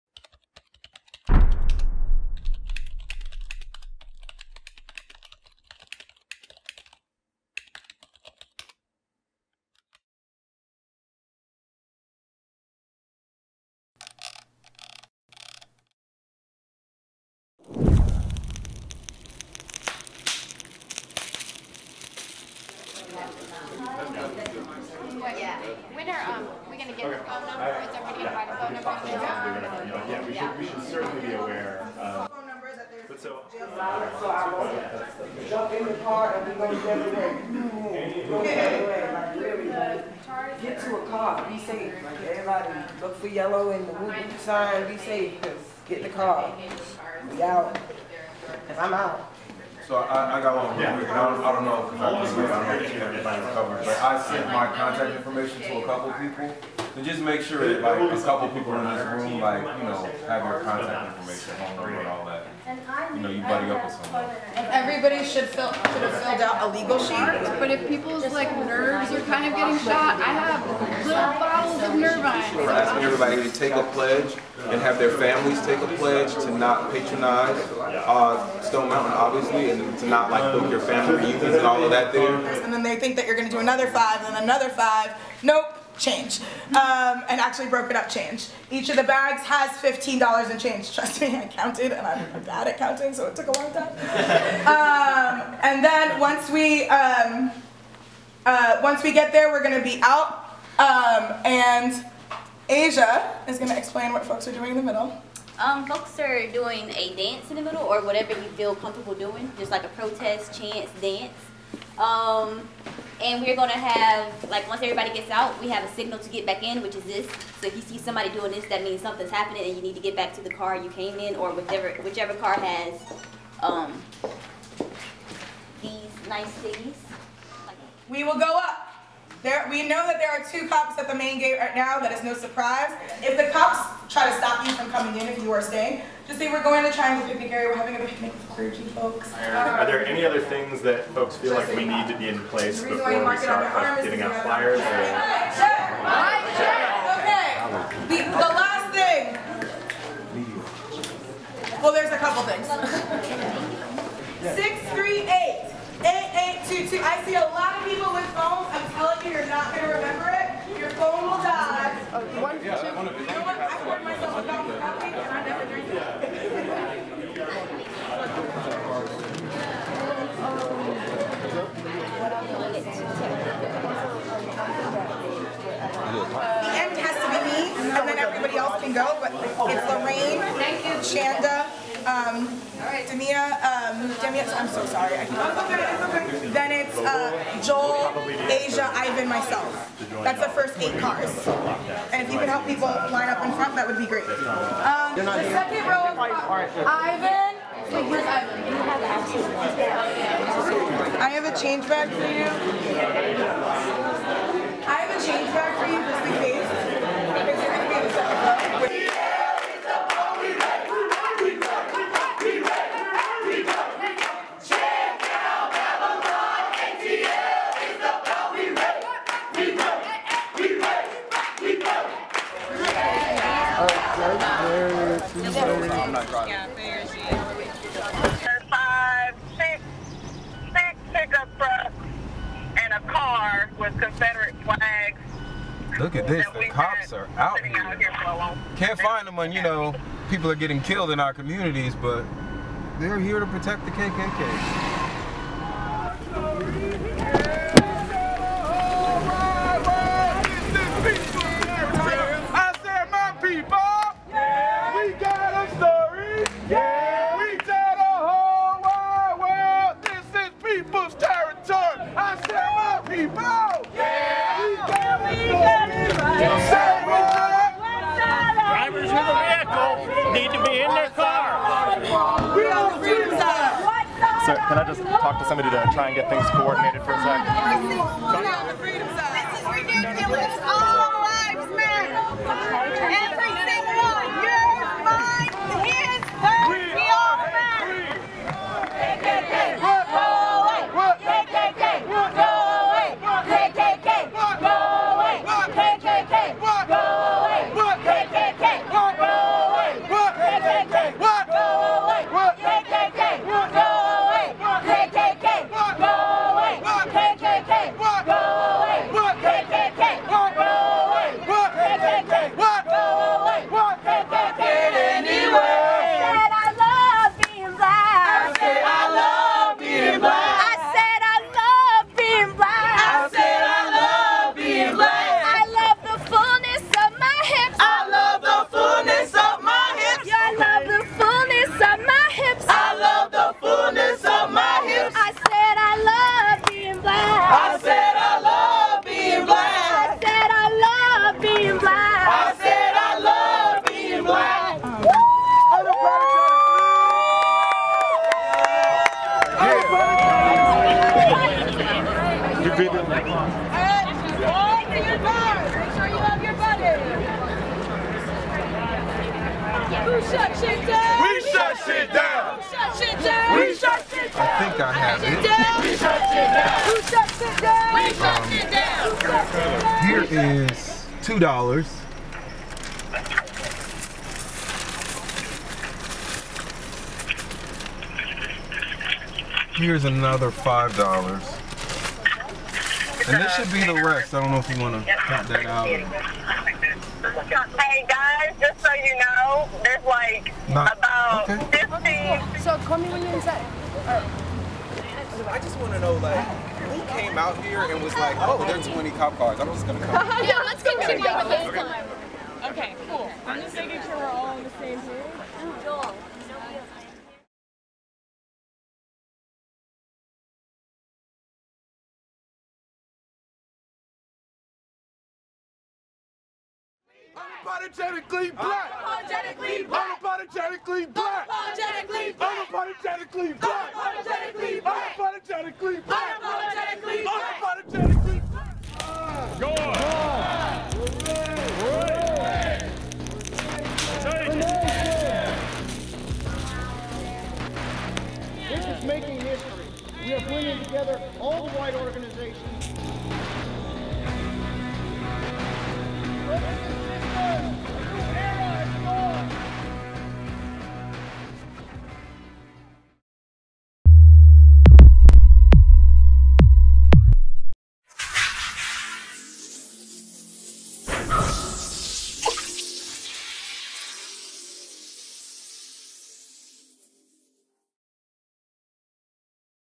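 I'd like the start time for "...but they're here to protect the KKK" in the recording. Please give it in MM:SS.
04:02.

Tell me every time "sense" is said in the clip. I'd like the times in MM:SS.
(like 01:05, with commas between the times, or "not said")
not said.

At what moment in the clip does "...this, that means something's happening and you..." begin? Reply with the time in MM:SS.
01:58.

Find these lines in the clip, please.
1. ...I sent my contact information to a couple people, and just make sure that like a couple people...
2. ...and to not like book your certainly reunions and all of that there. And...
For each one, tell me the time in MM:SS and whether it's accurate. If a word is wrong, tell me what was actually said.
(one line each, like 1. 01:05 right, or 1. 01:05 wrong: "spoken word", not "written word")
1. 00:54 right
2. 01:19 wrong: "family", not "certainly".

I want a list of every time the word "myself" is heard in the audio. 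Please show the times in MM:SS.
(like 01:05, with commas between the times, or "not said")
02:44, 03:09.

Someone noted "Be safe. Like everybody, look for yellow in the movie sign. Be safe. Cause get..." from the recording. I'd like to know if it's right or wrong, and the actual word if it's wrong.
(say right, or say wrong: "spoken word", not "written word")
right.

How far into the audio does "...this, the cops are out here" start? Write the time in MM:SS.
03:56.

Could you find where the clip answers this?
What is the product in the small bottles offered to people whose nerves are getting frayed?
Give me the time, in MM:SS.
01:11.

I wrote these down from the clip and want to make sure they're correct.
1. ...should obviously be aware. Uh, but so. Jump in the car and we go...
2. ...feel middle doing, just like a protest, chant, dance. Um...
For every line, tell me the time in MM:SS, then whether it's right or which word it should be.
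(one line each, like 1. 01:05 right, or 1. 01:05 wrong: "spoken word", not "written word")
1. 00:30 wrong: "certainly", not "obviously"
2. 01:48 wrong: "comfortable", not "middle".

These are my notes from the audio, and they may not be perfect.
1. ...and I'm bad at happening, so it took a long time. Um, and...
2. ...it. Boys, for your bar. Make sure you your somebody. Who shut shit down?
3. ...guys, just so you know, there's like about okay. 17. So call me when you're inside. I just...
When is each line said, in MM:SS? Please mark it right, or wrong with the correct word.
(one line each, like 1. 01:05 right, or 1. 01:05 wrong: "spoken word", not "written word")
1. 01:31 wrong: "counting", not "happening"
2. 05:52 wrong: "buddy", not "somebody"
3. 06:28 wrong: "15", not "17".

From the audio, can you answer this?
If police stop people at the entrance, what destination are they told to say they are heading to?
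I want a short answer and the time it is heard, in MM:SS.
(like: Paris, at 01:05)
Triangle Picnic Area, at 02:16.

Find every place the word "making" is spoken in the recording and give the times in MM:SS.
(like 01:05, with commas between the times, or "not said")
06:43, 07:19.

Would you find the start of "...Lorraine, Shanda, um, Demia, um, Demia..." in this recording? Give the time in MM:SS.
02:59.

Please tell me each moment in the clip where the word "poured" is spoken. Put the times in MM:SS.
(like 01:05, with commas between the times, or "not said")
02:43.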